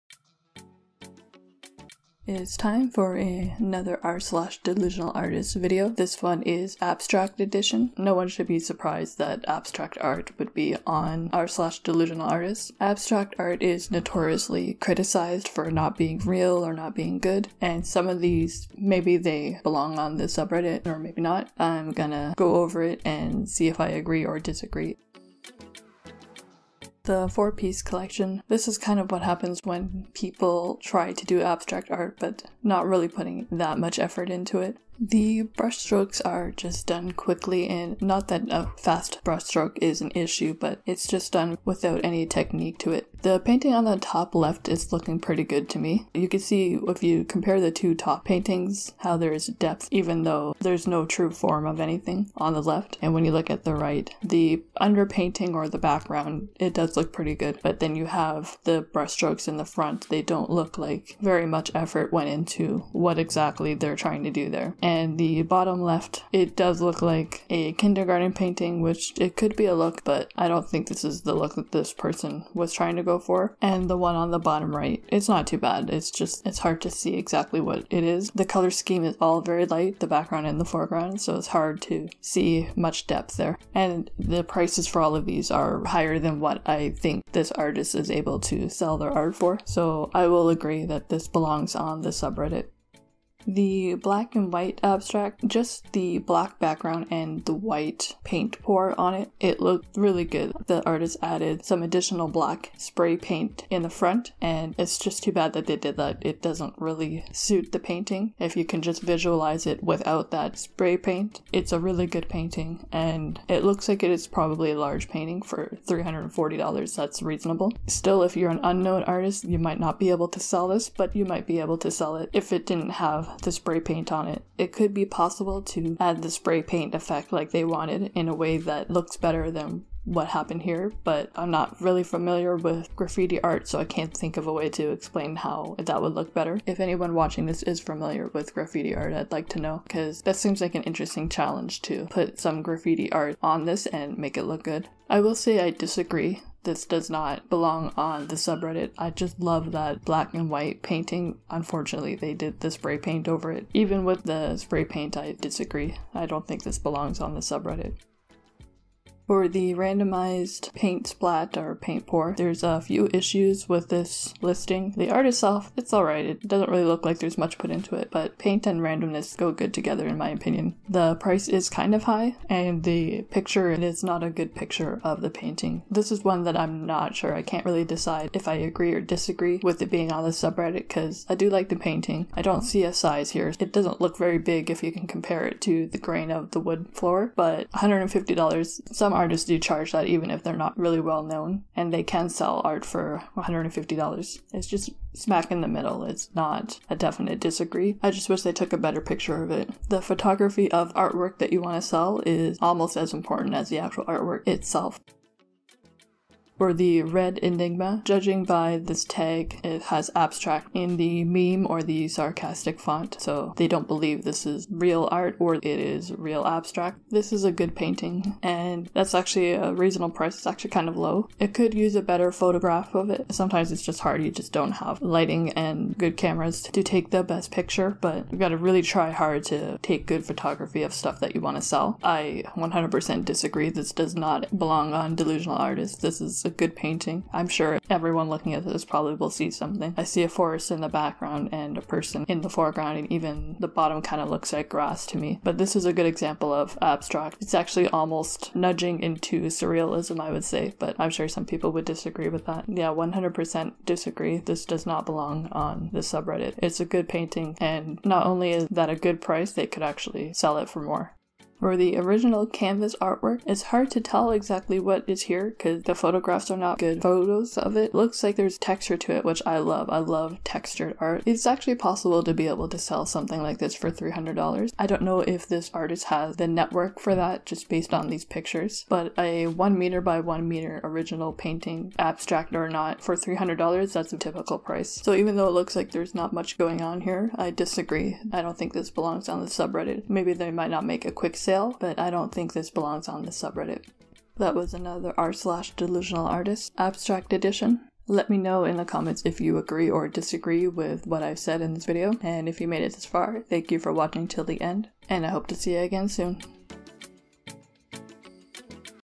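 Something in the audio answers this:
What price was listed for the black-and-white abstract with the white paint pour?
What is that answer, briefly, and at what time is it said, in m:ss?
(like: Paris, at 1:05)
$340, at 1:55.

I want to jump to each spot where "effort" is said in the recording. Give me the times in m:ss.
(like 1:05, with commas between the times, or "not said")
0:33, 1:01.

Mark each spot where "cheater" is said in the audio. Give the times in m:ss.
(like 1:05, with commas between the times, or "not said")
not said.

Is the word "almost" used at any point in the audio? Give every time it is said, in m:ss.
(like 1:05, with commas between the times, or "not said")
3:22, 4:07.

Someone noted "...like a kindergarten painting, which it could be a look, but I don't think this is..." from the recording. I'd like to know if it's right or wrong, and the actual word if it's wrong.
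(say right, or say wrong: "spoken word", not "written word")
right.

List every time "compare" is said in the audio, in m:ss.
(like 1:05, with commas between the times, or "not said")
0:47, 3:05.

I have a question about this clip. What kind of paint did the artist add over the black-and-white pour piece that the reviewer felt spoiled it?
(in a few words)
black spray paint.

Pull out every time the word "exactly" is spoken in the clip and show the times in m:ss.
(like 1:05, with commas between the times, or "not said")
1:03, 1:17, 4:24.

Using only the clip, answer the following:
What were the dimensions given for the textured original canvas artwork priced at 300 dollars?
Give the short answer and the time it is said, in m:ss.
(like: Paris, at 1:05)
1 meter by 1 meter, at 4:39.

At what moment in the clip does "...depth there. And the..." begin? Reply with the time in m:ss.
1:23.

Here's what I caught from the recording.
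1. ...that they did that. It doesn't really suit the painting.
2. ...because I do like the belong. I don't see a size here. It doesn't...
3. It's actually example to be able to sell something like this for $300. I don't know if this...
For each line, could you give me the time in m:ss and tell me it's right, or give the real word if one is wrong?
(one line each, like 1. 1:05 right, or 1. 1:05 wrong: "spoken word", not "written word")
1. 1:45 right
2. 3:00 wrong: "painting", not "belong"
3. 4:31 wrong: "possible", not "example".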